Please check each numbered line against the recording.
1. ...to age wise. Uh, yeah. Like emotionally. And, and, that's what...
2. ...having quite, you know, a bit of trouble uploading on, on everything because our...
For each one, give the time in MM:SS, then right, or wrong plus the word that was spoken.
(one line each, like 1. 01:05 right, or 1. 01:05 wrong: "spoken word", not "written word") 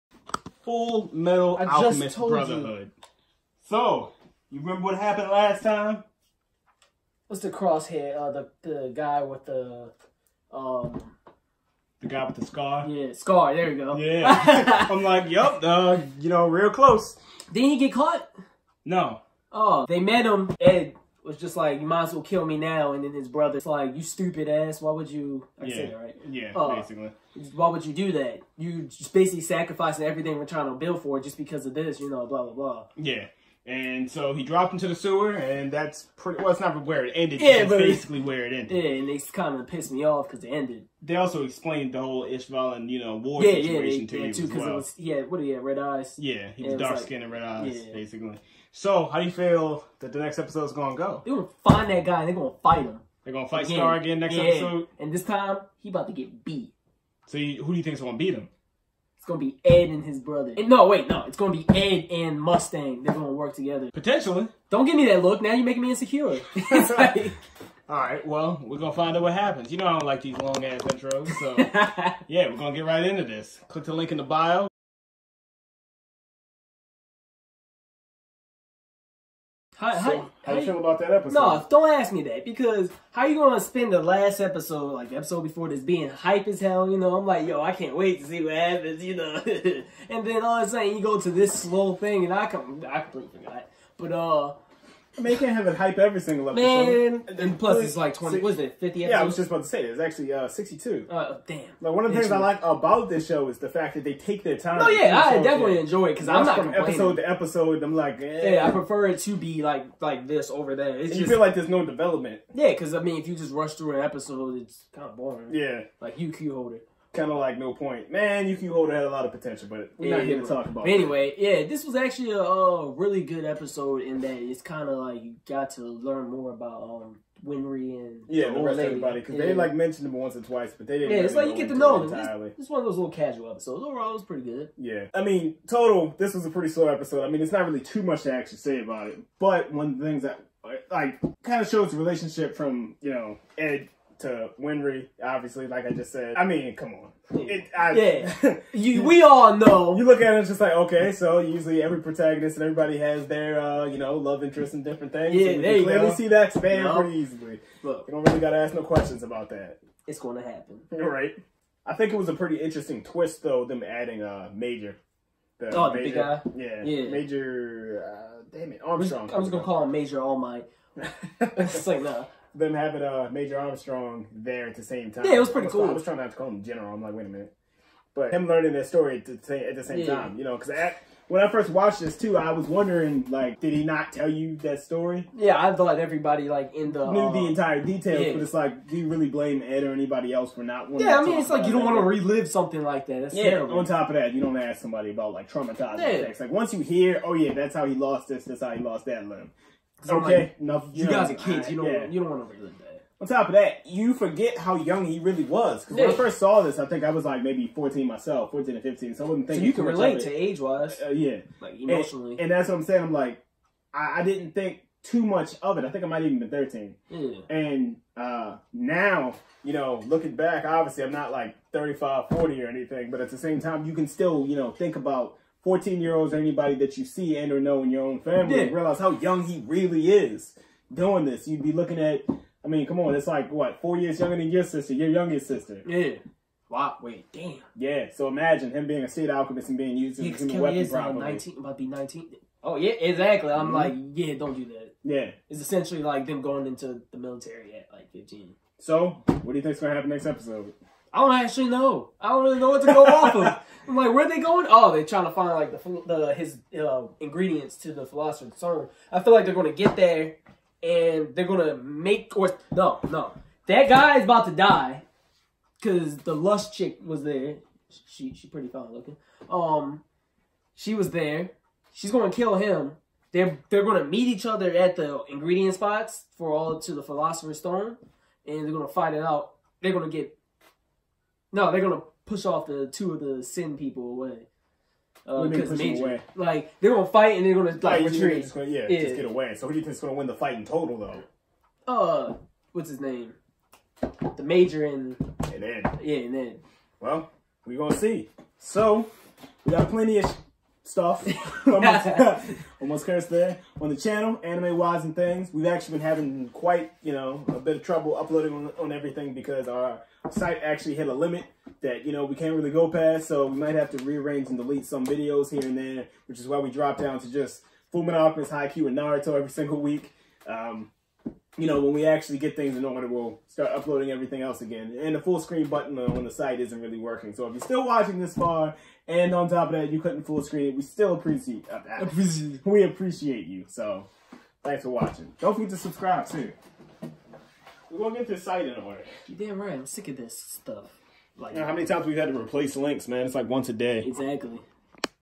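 1. 03:30 right
2. 05:06 right.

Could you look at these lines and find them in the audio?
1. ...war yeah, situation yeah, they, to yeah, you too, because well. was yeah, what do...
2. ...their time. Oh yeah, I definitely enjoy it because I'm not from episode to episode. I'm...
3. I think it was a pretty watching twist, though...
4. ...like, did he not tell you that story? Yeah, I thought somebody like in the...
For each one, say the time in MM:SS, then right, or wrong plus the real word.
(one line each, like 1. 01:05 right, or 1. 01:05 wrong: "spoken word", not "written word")
1. 00:43 right
2. 01:44 right
3. 02:41 wrong: "interesting", not "watching"
4. 03:03 wrong: "everybody", not "somebody".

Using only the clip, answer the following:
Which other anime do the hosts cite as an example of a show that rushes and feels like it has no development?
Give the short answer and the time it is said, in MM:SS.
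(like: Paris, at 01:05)
UQ Holder, at 01:56.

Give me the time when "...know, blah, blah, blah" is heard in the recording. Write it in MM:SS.
00:32.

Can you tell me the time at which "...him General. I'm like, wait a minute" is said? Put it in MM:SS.
02:56.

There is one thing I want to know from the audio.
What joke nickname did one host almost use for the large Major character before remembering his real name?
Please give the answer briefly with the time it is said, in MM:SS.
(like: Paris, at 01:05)
Major All Might, at 02:49.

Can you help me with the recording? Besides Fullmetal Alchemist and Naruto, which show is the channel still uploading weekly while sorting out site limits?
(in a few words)
Haikyuu.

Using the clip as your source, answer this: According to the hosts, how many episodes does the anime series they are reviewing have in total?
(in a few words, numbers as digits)
62.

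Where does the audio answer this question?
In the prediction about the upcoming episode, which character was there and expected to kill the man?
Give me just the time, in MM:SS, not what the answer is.
04:26.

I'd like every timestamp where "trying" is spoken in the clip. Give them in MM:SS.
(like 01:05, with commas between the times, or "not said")
00:30, 02:56, 04:15.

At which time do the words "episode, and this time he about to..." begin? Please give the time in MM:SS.
00:54.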